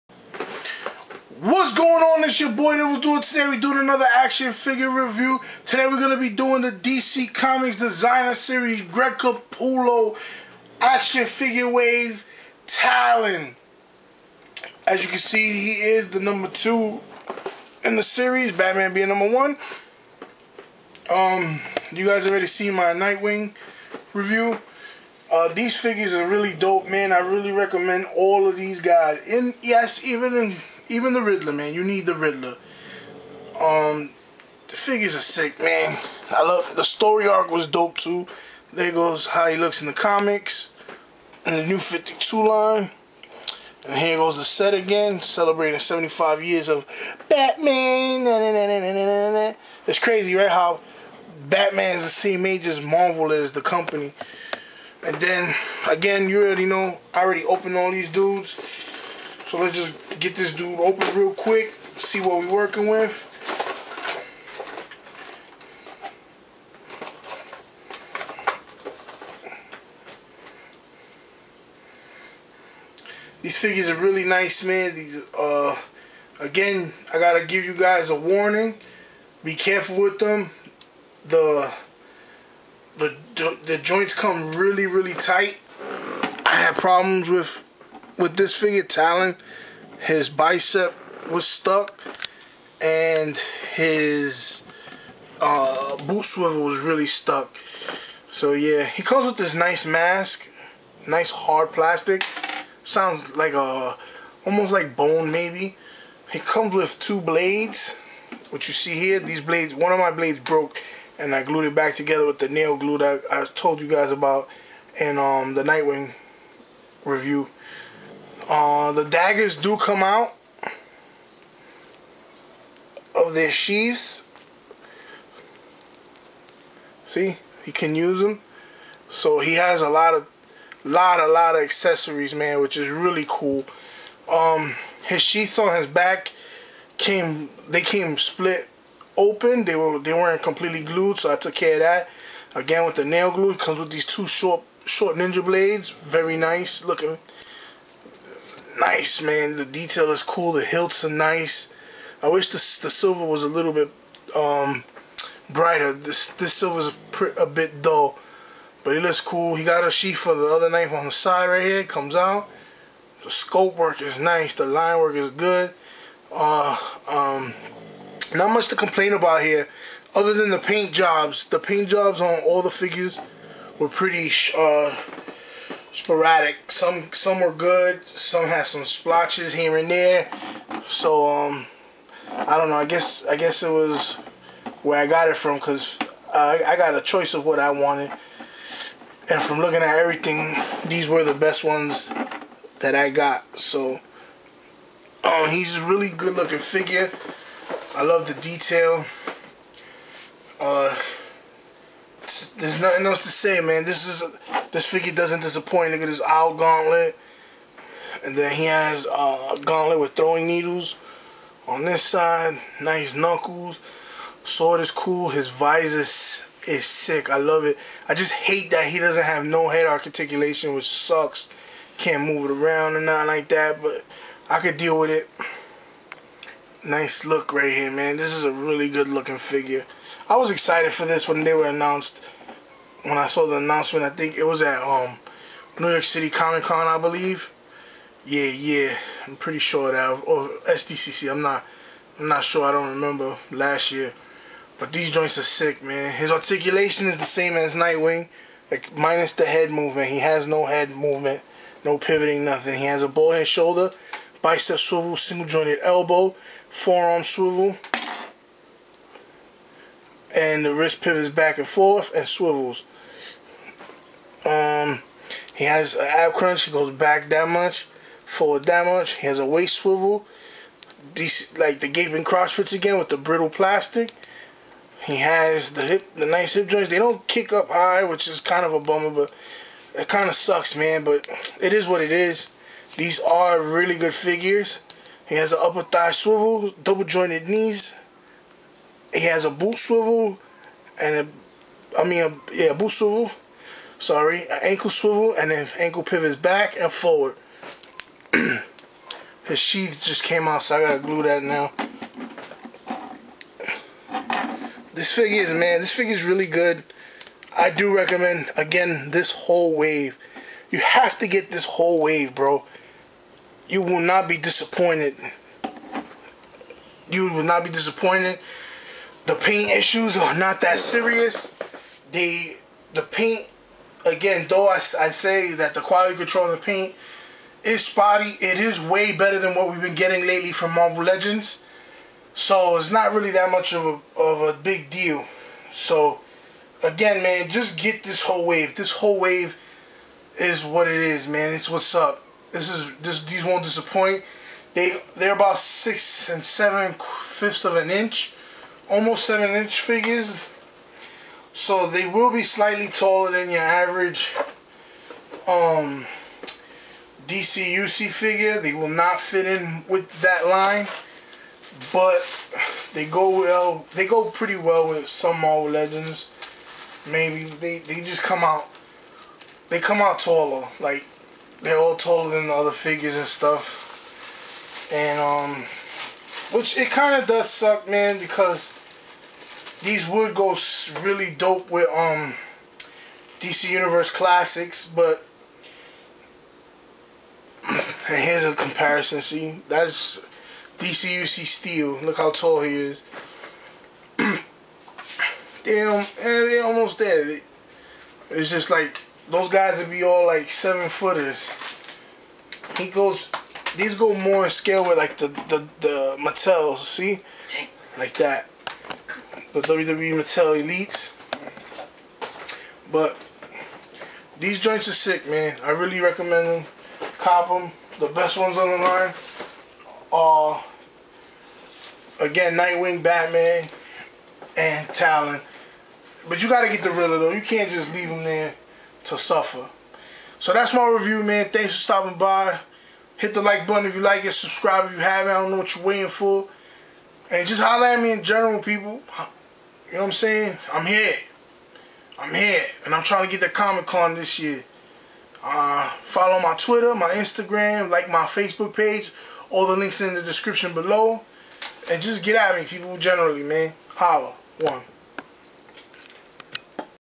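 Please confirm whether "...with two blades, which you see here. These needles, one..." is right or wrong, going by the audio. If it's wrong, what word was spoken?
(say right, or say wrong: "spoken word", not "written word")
wrong: "blades", not "needles".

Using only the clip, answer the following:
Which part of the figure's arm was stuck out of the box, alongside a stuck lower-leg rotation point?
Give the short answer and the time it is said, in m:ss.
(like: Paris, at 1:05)
His bicep, at 1:29.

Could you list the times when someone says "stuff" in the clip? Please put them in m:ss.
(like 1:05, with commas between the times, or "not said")
6:13.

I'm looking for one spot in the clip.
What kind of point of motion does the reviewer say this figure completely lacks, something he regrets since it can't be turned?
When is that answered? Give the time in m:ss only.
3:39.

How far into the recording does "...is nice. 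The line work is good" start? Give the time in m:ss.
2:44.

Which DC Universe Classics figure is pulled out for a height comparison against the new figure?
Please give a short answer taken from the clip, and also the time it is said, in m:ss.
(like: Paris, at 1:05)
Steel, at 6:31.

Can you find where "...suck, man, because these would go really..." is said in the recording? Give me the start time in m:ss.
6:17.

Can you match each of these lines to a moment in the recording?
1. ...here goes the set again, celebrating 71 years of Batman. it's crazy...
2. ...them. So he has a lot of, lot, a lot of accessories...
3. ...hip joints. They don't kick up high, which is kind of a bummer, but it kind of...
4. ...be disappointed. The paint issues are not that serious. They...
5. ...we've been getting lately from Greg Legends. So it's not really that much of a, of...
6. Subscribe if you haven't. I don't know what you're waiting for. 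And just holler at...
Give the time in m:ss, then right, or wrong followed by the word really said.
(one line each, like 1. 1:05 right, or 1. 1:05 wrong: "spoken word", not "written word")
1. 0:43 wrong: "75", not "71"
2. 2:08 right
3. 4:36 right
4. 5:17 right
5. 5:29 wrong: "Marvel", not "Greg"
6. 7:14 right.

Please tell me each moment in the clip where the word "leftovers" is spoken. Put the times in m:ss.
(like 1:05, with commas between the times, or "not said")
not said.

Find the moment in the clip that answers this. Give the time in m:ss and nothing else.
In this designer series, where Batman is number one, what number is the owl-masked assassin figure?
0:16.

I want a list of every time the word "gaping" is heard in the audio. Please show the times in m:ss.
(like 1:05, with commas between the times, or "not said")
4:31.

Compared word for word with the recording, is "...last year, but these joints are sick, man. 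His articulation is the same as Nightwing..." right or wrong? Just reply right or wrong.
right.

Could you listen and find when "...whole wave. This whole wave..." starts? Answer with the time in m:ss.
5:38.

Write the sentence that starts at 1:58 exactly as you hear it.
Uh, the daggers do come out of their sheaths.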